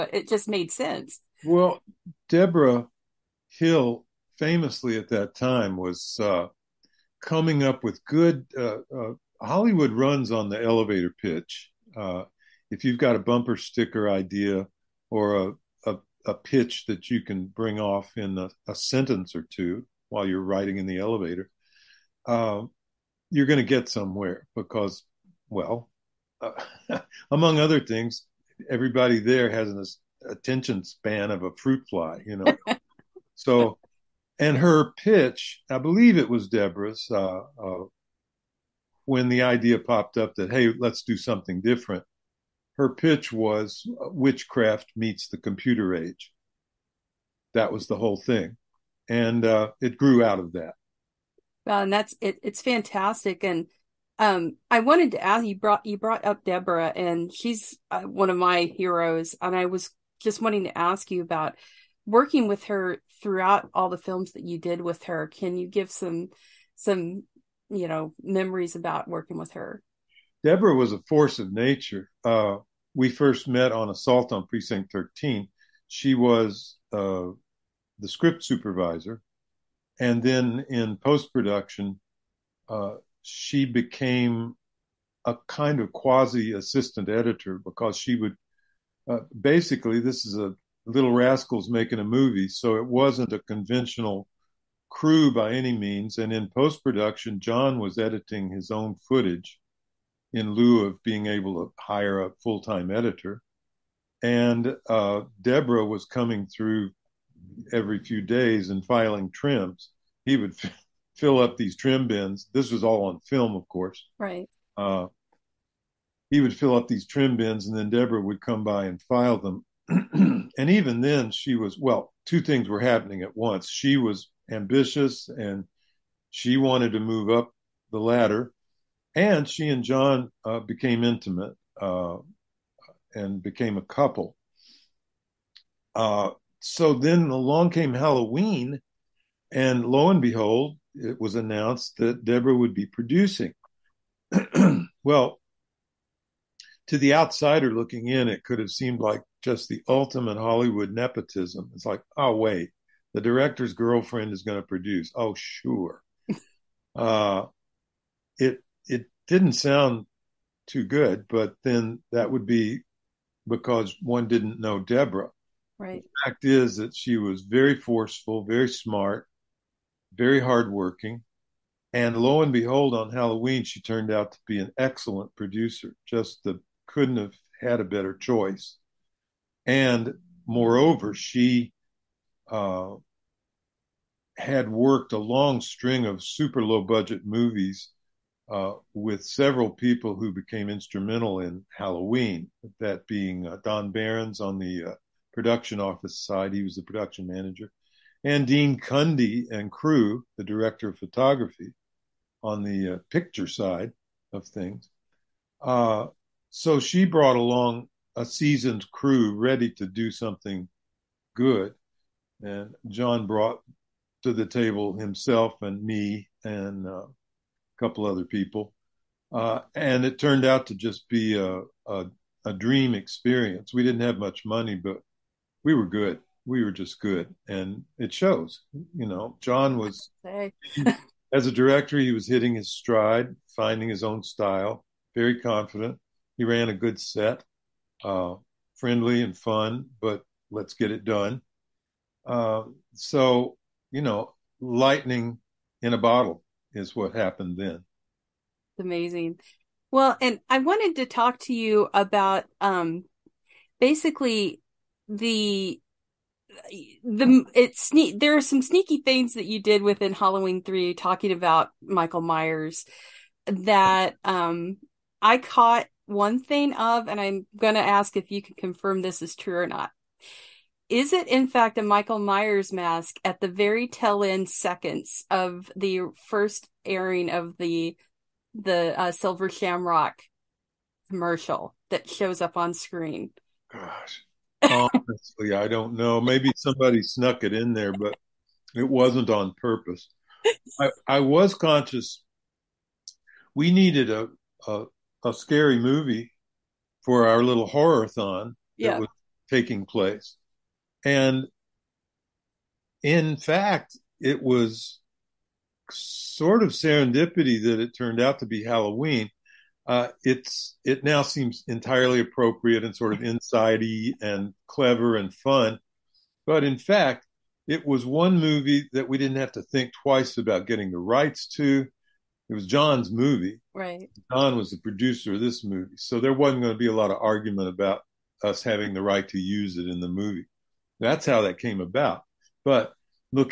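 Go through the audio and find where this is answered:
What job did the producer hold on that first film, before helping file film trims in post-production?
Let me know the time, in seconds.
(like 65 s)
78 s.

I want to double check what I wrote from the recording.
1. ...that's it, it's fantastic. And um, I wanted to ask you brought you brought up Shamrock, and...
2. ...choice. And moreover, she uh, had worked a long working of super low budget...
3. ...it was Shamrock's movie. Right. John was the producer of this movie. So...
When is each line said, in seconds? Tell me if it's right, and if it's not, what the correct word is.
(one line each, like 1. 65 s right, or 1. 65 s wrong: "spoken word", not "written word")
1. 51 s wrong: "Deborah", not "Shamrock"
2. 178 s wrong: "string", not "working"
3. 322 s wrong: "John", not "Shamrock".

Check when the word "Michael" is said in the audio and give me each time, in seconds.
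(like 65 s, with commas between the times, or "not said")
261 s, 271 s.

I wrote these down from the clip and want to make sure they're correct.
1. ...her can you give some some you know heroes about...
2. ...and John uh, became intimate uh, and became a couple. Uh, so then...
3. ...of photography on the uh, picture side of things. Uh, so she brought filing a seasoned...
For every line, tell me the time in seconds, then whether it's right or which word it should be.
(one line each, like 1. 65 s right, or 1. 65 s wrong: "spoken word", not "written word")
1. 65 s wrong: "memories", not "heroes"
2. 129 s right
3. 200 s wrong: "along", not "filing".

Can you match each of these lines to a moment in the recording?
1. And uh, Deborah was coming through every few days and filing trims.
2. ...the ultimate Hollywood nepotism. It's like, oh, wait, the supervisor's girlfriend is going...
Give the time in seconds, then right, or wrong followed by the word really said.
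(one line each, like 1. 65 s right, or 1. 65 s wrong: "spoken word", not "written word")
1. 104 s right
2. 149 s wrong: "director", not "supervisor".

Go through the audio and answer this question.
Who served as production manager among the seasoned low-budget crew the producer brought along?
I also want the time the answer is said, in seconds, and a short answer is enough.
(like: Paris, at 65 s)
Don Behrns, at 193 s.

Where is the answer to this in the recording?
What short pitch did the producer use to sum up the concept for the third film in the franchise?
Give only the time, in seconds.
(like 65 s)
44 s.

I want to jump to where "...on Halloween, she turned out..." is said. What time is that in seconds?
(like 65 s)
172 s.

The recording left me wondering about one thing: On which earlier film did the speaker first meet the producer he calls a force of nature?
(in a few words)
Assault on Precinct 13.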